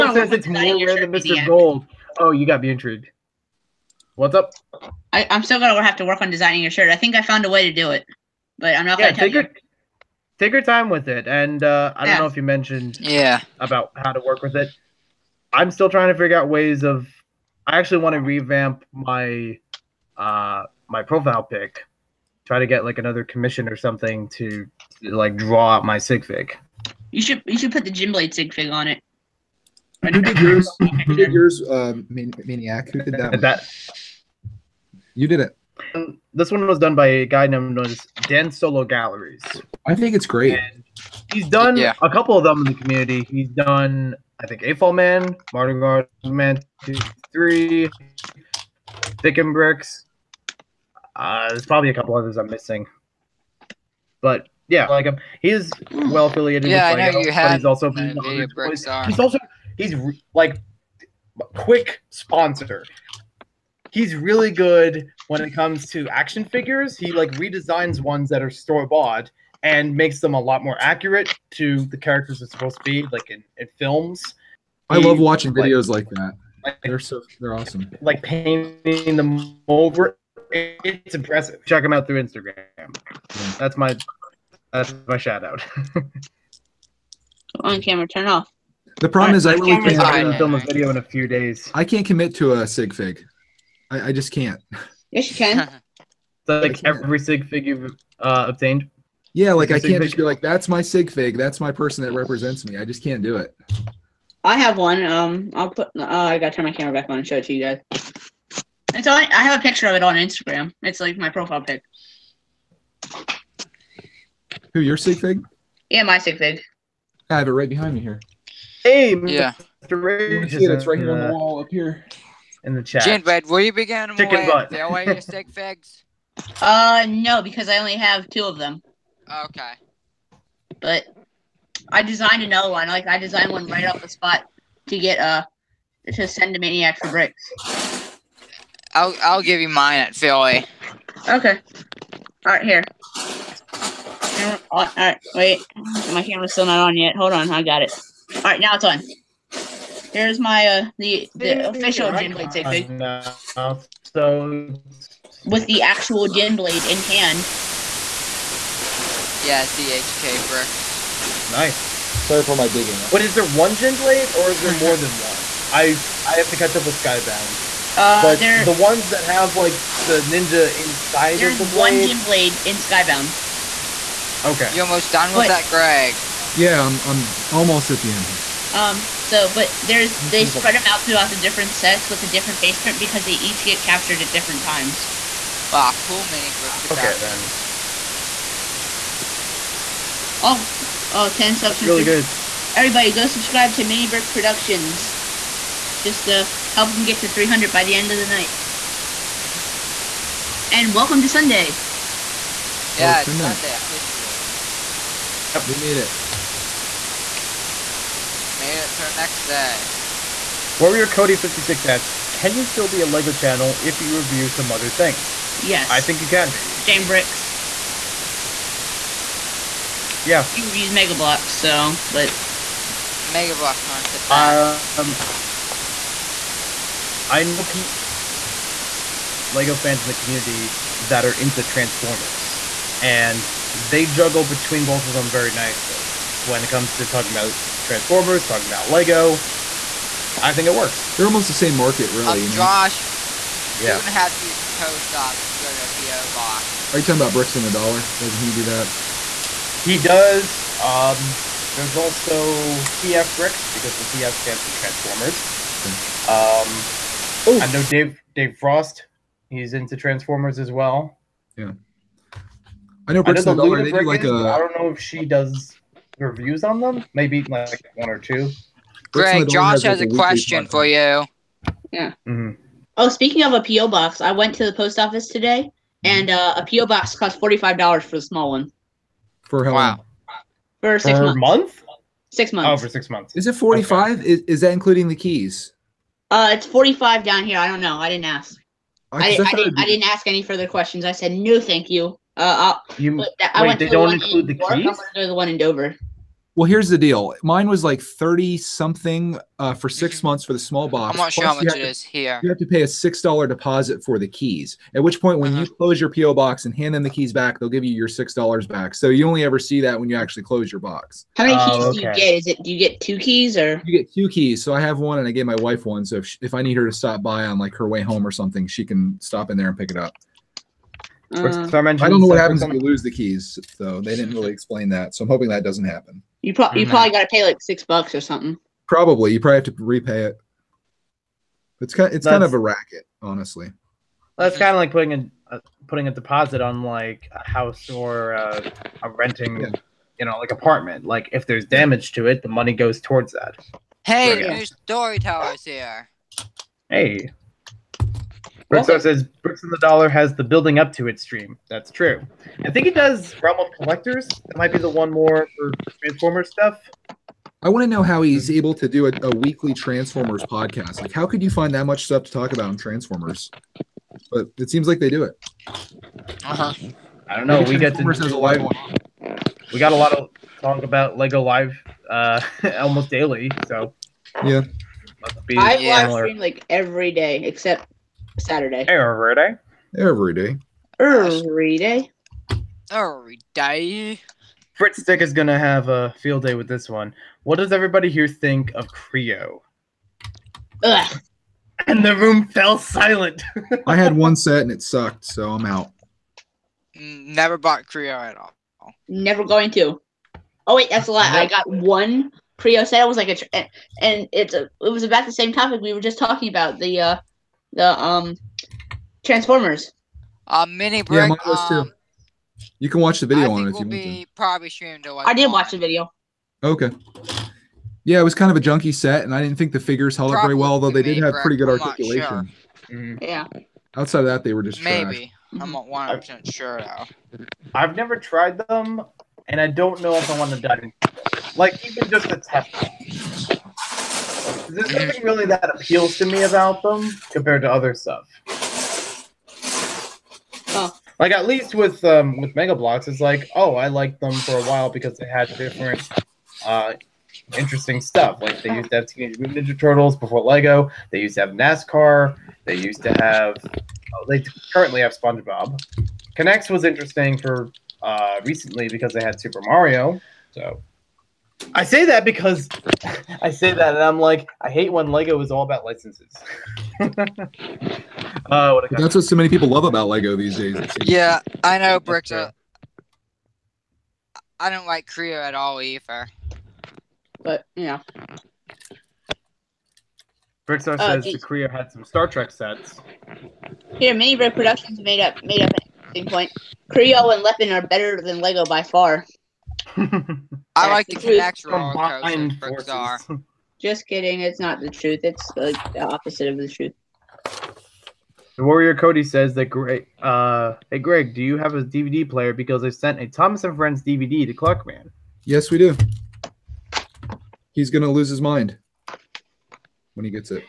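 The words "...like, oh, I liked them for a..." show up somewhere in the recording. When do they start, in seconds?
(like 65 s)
443 s.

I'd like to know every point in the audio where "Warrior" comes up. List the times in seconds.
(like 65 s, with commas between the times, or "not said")
210 s, 498 s.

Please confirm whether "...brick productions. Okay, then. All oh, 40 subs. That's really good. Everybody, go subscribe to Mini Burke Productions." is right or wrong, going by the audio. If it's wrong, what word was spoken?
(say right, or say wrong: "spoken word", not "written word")
wrong: "10", not "40".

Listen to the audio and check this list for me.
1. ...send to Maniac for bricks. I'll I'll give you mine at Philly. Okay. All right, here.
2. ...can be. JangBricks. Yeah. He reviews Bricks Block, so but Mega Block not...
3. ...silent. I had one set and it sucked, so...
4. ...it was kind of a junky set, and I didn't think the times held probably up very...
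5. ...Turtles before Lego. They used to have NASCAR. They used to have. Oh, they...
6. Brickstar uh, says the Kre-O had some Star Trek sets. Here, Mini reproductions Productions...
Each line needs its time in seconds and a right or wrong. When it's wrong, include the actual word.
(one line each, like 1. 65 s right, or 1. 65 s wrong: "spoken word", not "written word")
1. 136 s right
2. 216 s wrong: "Mega", not "Bricks"
3. 392 s right
4. 418 s wrong: "figures", not "times"
5. 449 s right
6. 480 s right.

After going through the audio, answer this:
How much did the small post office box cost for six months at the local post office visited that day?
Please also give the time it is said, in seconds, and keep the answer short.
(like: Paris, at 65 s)
$45, at 277 s.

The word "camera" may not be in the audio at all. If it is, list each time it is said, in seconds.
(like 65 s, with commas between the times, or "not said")
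87 s, 106 s, 146 s.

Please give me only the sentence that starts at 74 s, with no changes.
I love watching videos like, like that.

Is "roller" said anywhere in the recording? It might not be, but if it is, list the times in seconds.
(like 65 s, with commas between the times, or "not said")
491 s.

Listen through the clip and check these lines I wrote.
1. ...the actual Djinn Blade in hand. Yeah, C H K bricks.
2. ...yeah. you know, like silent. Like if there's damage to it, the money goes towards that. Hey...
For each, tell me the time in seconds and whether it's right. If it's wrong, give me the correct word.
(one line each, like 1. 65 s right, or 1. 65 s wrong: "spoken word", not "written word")
1. 155 s right
2. 339 s wrong: "apartment", not "silent".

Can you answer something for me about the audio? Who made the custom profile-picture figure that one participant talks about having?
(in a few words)
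Dan Solo Galleries.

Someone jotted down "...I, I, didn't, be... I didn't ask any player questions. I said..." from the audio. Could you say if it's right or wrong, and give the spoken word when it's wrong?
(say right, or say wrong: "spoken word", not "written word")
wrong: "further", not "player".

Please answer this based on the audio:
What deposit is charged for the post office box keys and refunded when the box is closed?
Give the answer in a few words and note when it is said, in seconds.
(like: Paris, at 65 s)
$6, at 302 s.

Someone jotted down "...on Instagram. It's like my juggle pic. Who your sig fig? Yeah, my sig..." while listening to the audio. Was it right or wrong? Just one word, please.
wrong.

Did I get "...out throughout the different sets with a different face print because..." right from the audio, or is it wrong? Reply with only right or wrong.
right.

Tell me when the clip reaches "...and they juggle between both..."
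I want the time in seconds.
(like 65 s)
233 s.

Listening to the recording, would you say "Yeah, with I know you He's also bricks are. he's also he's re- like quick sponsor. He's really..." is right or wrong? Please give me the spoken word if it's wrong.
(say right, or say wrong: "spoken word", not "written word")
right.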